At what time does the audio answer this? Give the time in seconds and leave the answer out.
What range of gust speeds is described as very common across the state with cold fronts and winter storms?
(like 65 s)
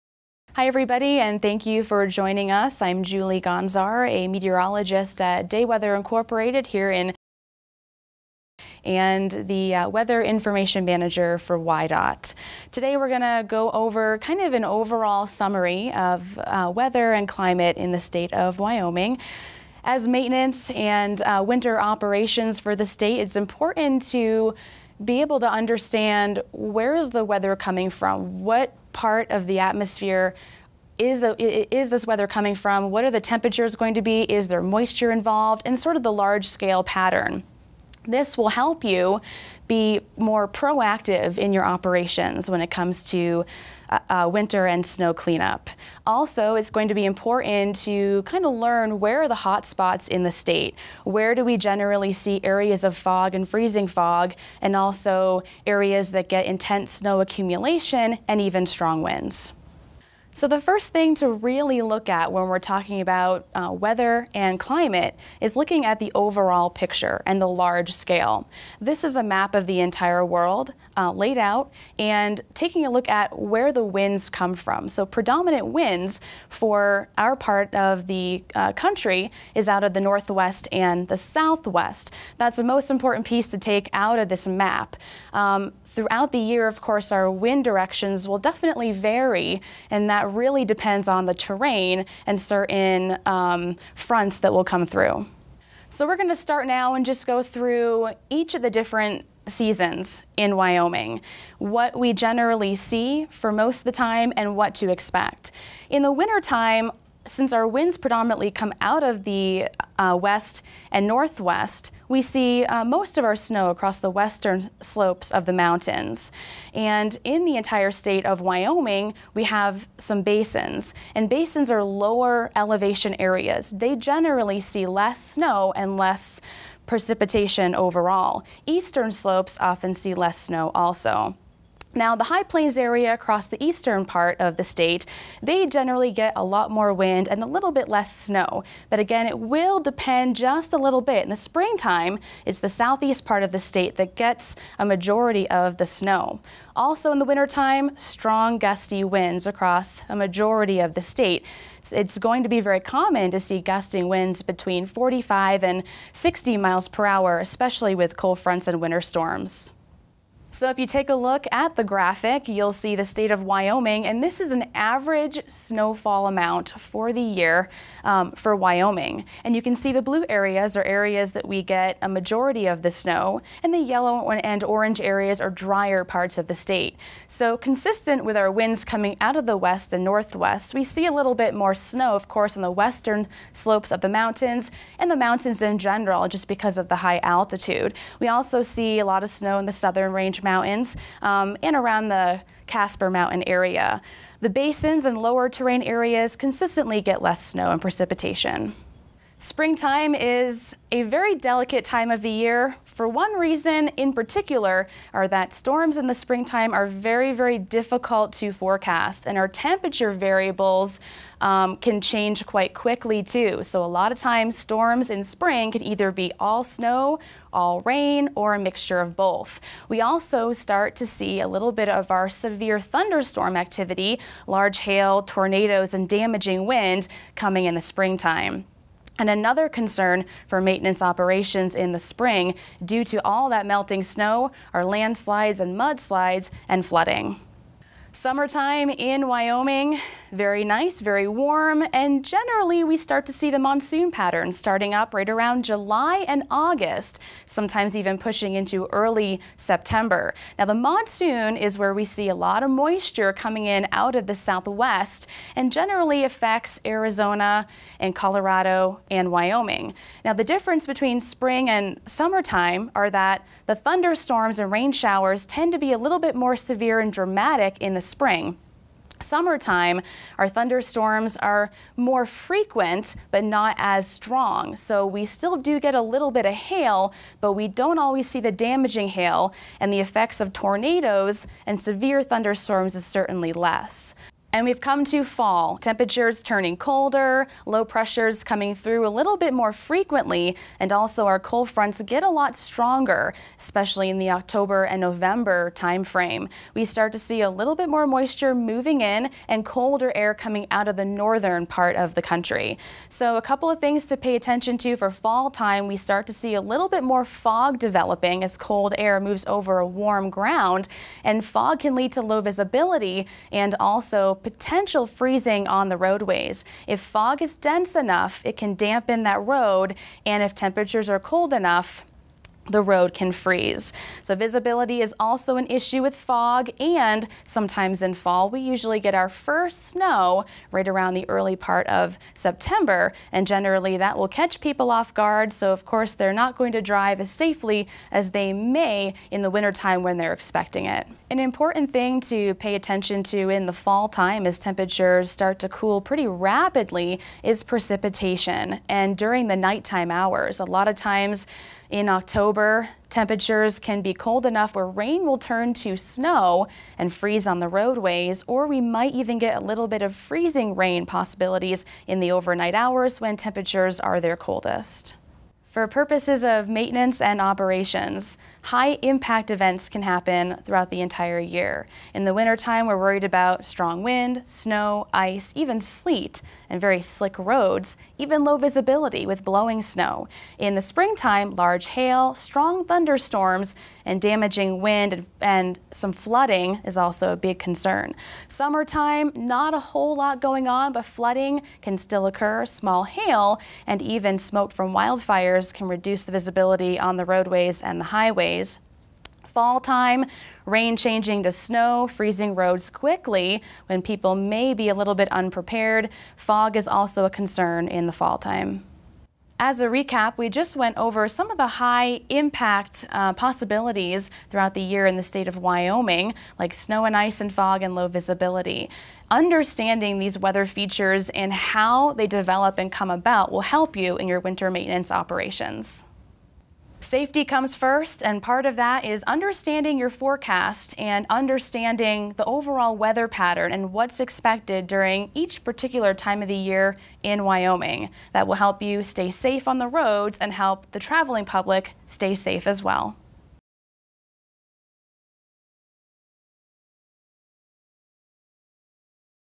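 154 s.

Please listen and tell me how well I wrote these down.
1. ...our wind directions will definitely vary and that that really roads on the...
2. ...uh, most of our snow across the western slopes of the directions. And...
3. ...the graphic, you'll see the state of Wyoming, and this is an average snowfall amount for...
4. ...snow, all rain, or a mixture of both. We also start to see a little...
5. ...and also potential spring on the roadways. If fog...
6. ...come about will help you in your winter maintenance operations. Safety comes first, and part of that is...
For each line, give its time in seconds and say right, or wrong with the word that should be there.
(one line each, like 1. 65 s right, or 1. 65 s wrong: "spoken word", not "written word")
1. 87 s wrong: "depends", not "roads"
2. 112 s wrong: "mountains", not "directions"
3. 161 s right
4. 216 s right
5. 313 s wrong: "freezing", not "spring"
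6. 422 s right.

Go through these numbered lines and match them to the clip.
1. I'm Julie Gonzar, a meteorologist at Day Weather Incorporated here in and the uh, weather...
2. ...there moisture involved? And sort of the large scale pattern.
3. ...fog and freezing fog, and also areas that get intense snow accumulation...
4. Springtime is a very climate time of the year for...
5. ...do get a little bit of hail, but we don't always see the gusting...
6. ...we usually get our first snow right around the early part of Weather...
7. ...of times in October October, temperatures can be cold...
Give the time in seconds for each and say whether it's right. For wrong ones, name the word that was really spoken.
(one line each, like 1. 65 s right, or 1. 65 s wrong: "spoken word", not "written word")
1. 2 s right
2. 34 s right
3. 52 s right
4. 199 s wrong: "delicate", not "climate"
5. 275 s wrong: "damaging", not "gusting"
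6. 328 s wrong: "September", not "Weather"
7. 350 s right.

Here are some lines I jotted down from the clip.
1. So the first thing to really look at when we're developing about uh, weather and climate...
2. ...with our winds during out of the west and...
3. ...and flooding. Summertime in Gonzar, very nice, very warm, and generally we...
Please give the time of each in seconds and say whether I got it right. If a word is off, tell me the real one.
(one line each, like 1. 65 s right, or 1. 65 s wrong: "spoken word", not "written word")
1. 60 s wrong: "talking", not "developing"
2. 178 s wrong: "coming", not "during"
3. 236 s wrong: "Wyoming", not "Gonzar".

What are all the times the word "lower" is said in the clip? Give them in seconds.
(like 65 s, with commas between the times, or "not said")
121 s, 195 s.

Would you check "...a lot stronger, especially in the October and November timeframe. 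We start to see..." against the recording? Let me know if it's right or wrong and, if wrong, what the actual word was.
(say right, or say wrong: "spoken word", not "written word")
right.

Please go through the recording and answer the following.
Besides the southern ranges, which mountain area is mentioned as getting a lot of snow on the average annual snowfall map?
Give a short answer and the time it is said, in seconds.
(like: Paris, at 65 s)
Casper Mountain, at 192 s.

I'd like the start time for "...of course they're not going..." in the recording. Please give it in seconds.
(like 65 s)
335 s.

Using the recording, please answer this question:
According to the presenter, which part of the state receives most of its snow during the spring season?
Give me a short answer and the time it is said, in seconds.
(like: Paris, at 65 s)
Southeast, at 142 s.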